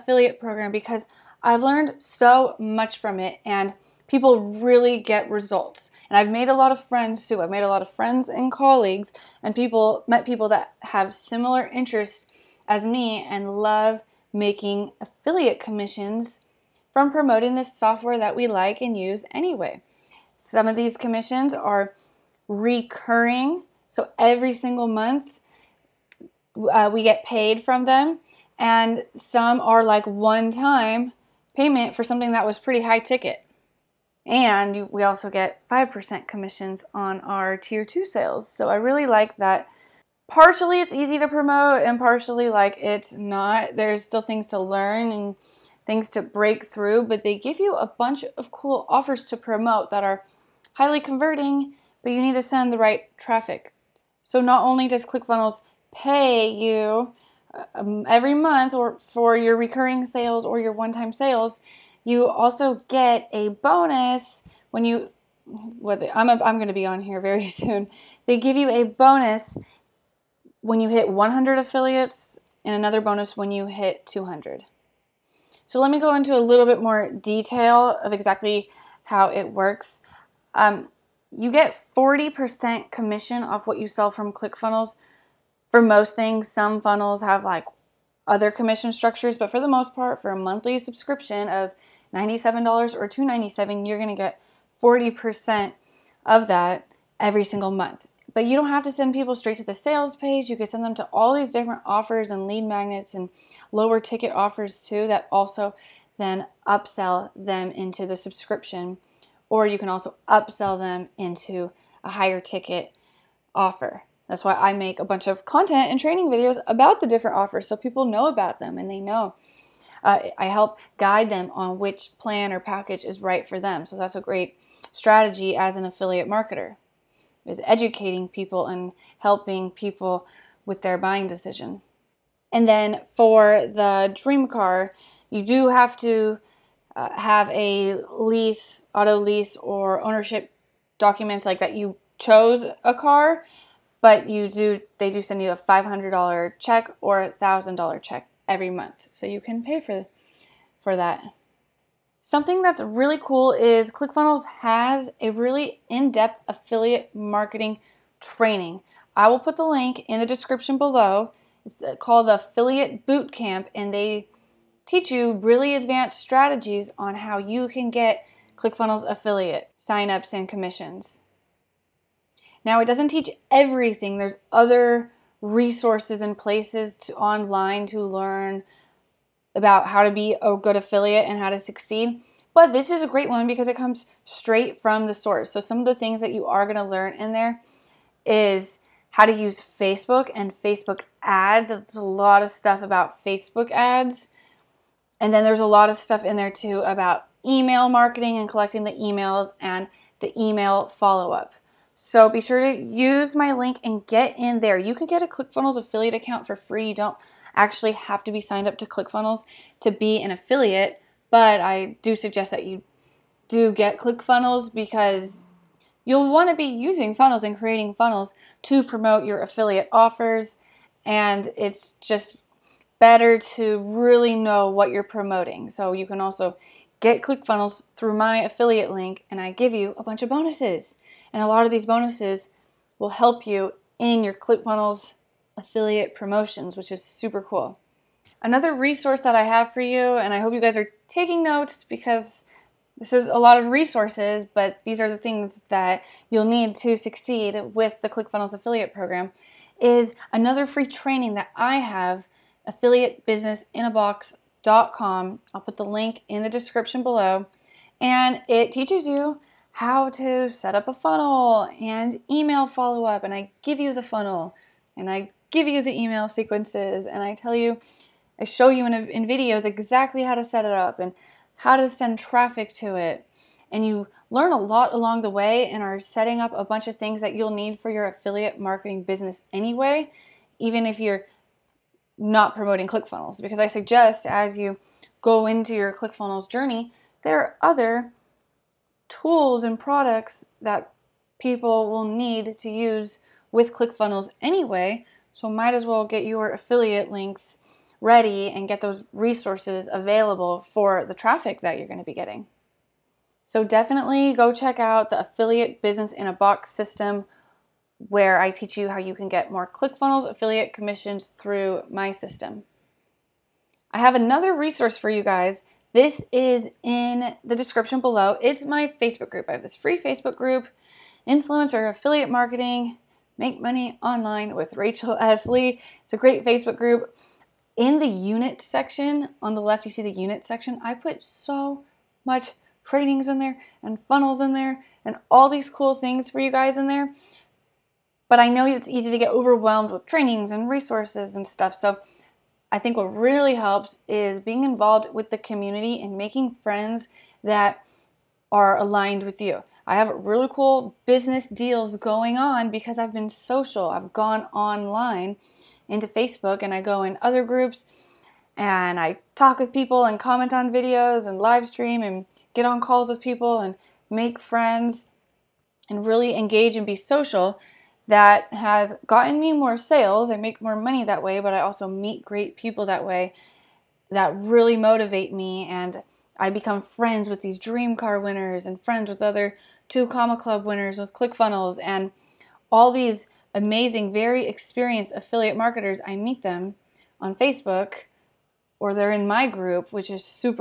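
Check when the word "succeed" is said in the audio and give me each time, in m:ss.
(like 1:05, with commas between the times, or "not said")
3:01, 4:06.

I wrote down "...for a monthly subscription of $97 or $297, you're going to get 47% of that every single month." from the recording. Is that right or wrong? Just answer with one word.
wrong.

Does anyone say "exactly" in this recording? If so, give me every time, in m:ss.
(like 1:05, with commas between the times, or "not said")
1:18, 4:29.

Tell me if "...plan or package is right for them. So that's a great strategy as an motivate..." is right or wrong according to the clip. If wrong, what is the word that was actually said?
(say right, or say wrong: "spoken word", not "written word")
wrong: "affiliate", not "motivate".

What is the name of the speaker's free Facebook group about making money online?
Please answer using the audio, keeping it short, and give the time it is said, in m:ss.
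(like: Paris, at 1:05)
Influencer Affiliate Marketing, at 5:21.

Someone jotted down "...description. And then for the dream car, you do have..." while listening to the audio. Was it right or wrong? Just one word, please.
wrong.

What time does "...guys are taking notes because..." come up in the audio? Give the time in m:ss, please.
4:00.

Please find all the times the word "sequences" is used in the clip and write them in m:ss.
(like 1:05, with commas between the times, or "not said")
4:26.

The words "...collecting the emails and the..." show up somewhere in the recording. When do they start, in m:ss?
3:18.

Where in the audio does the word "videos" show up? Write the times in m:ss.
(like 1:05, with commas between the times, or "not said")
1:56, 4:29, 6:00.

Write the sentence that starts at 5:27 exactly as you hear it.
In the unit section, on the left, you see the unit section.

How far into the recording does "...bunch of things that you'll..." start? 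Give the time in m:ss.
4:36.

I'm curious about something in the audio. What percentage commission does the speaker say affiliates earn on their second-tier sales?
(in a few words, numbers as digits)
5%.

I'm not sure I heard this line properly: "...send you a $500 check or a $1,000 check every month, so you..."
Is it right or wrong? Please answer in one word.
right.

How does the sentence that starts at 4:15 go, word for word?
I'll put the link in the description below.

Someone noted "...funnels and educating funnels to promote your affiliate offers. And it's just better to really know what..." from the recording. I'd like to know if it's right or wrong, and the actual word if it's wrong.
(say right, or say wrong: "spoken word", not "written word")
wrong: "creating", not "educating".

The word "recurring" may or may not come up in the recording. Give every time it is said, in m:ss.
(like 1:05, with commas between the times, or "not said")
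0:22, 0:59.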